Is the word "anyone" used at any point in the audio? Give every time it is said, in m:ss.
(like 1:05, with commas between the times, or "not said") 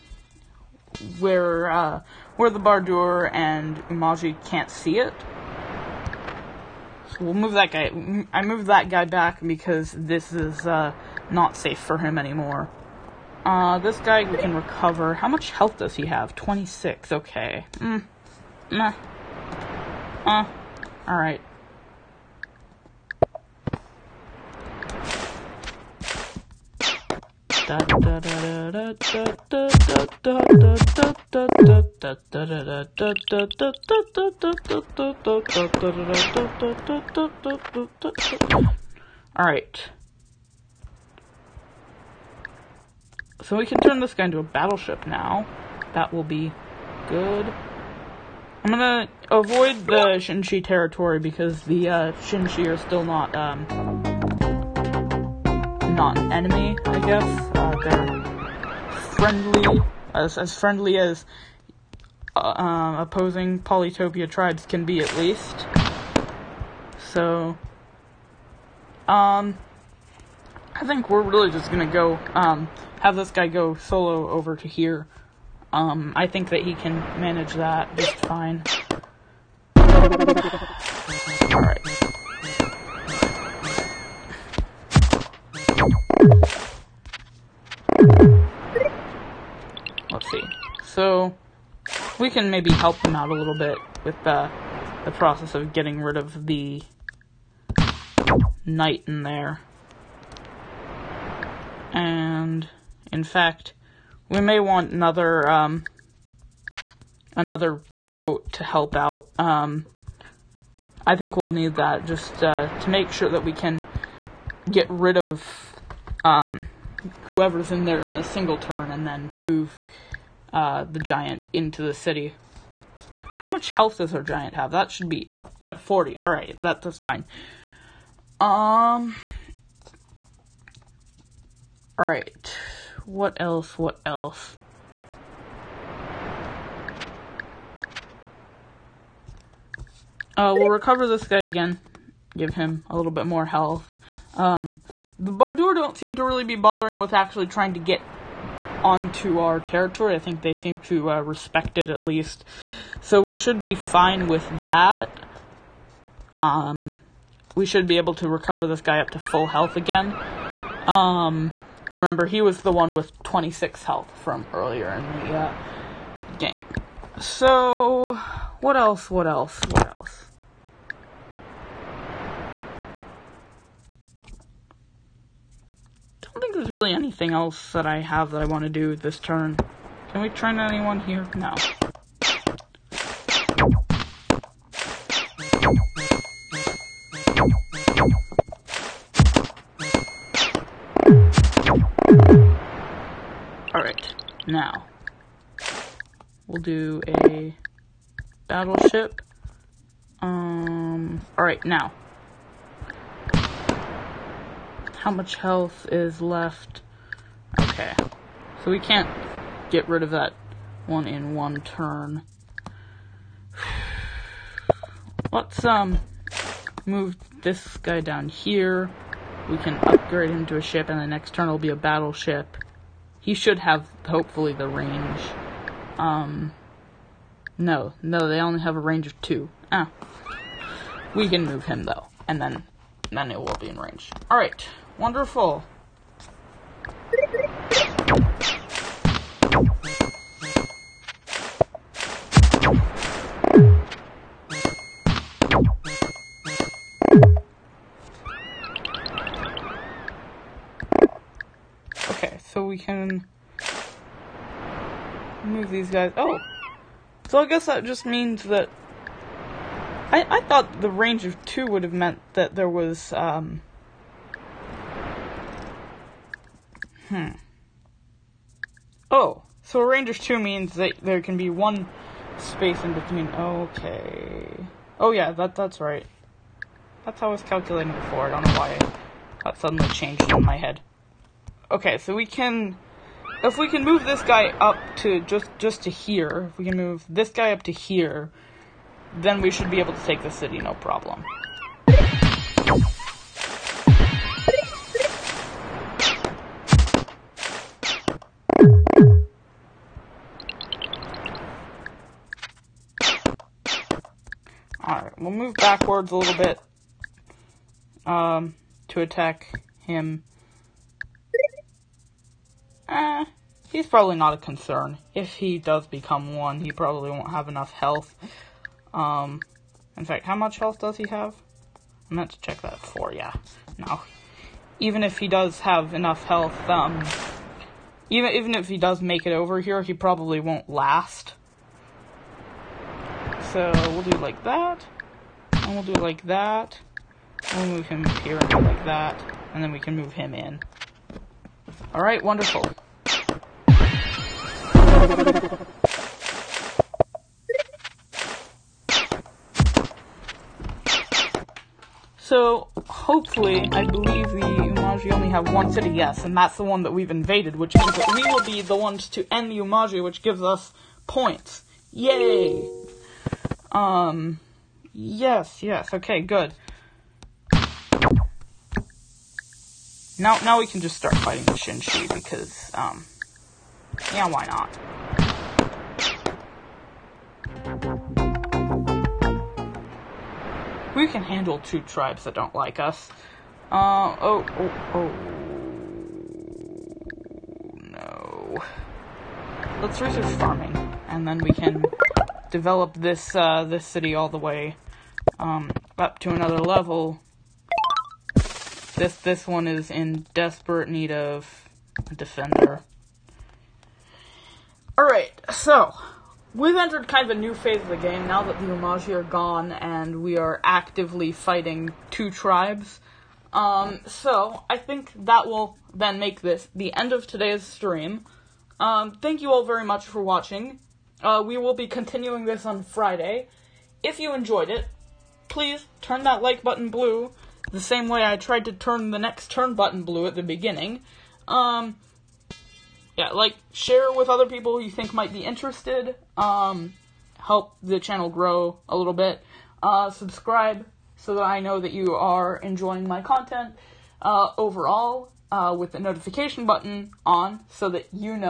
3:00.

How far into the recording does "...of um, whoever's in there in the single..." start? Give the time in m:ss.
1:55.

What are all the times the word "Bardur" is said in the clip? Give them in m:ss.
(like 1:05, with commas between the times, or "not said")
0:02, 2:25.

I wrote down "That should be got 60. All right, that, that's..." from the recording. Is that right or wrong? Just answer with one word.
wrong.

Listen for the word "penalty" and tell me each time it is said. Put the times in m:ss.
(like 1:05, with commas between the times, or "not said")
not said.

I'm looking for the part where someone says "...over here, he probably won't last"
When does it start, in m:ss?
5:29.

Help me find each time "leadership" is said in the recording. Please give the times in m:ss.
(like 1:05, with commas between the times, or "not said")
not said.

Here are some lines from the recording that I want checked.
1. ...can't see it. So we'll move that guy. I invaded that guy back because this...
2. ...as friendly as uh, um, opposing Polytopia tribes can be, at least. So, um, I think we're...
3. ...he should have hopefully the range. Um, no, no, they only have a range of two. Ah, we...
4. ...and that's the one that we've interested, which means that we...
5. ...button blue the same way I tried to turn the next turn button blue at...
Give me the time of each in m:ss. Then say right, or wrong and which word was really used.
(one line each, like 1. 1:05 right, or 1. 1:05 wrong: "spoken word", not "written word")
1. 0:04 wrong: "moved", not "invaded"
2. 1:00 right
3. 3:43 right
4. 5:56 wrong: "invaded", not "interested"
5. 7:06 right.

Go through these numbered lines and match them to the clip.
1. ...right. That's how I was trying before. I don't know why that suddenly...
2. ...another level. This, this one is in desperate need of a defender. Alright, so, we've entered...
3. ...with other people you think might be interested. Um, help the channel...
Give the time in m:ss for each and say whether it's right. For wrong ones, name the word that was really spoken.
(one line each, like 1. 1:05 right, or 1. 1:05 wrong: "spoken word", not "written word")
1. 4:35 wrong: "calculating", not "trying"
2. 6:36 right
3. 7:14 right.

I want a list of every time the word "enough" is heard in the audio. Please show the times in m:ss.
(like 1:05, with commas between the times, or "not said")
5:17, 5:25.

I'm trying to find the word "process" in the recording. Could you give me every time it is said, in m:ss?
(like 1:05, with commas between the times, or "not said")
1:35.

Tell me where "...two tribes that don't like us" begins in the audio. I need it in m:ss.
6:21.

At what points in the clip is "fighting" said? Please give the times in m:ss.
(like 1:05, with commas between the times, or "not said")
6:11, 6:51.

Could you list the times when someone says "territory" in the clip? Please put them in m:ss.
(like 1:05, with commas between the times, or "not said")
0:50, 2:29.